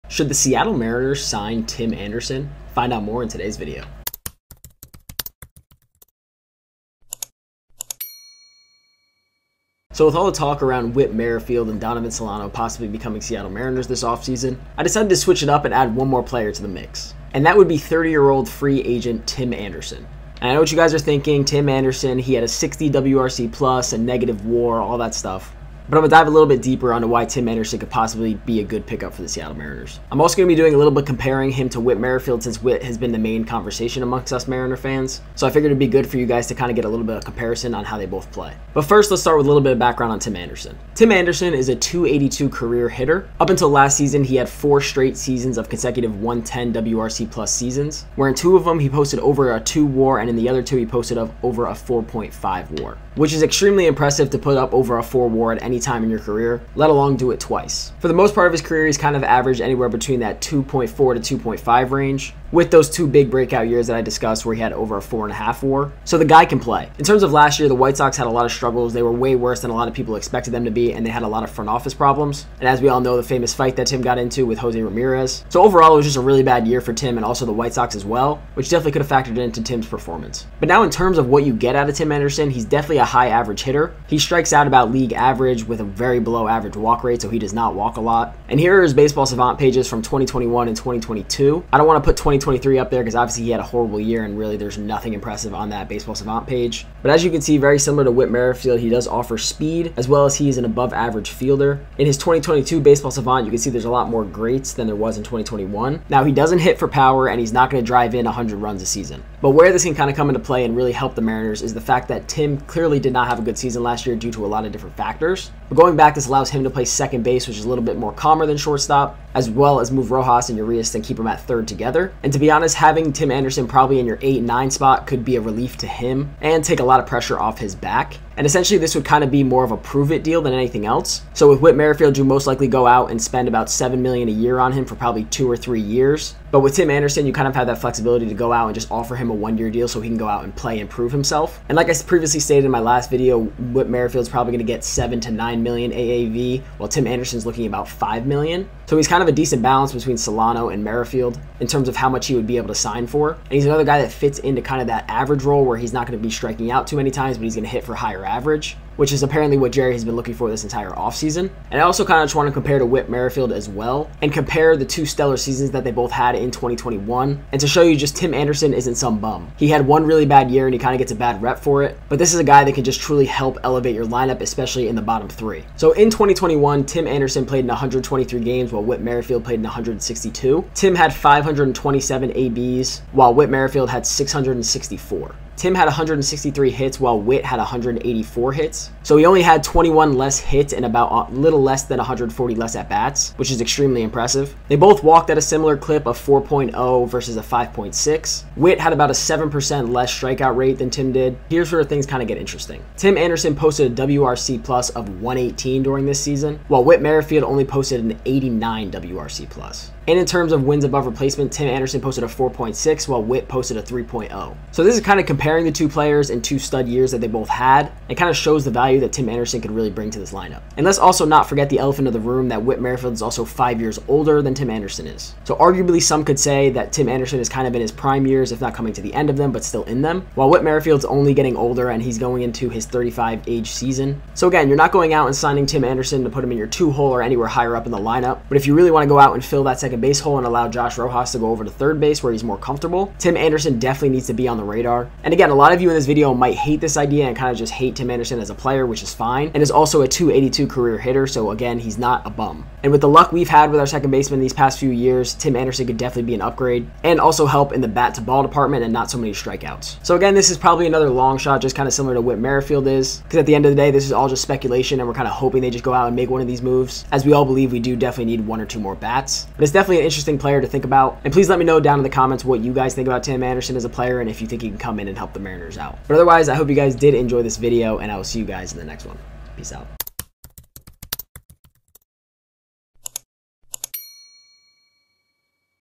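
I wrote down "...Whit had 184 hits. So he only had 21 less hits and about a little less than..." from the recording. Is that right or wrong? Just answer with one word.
right.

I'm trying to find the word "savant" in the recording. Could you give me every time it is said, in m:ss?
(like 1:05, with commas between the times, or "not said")
1:29, 1:36, 1:43.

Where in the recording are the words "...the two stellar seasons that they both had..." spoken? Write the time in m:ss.
2:44.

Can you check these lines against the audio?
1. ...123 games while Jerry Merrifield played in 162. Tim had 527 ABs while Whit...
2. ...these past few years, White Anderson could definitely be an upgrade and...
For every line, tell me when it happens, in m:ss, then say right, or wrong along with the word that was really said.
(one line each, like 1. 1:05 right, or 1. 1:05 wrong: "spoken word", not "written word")
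1. 2:57 wrong: "Whit", not "Jerry"
2. 4:14 wrong: "Tim", not "White".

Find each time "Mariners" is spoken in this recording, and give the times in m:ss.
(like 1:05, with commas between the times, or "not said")
0:00, 0:13, 0:29, 0:34, 1:51, 4:35.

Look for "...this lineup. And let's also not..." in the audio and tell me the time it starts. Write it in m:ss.
3:40.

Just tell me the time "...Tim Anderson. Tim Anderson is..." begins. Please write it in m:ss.
0:40.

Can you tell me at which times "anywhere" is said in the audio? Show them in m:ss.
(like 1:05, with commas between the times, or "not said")
0:59, 3:57.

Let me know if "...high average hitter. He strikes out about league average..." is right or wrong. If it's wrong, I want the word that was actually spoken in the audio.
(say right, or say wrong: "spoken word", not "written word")
right.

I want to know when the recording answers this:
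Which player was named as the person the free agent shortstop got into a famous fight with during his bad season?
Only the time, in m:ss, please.
1:14.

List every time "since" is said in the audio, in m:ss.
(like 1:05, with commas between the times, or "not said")
0:32.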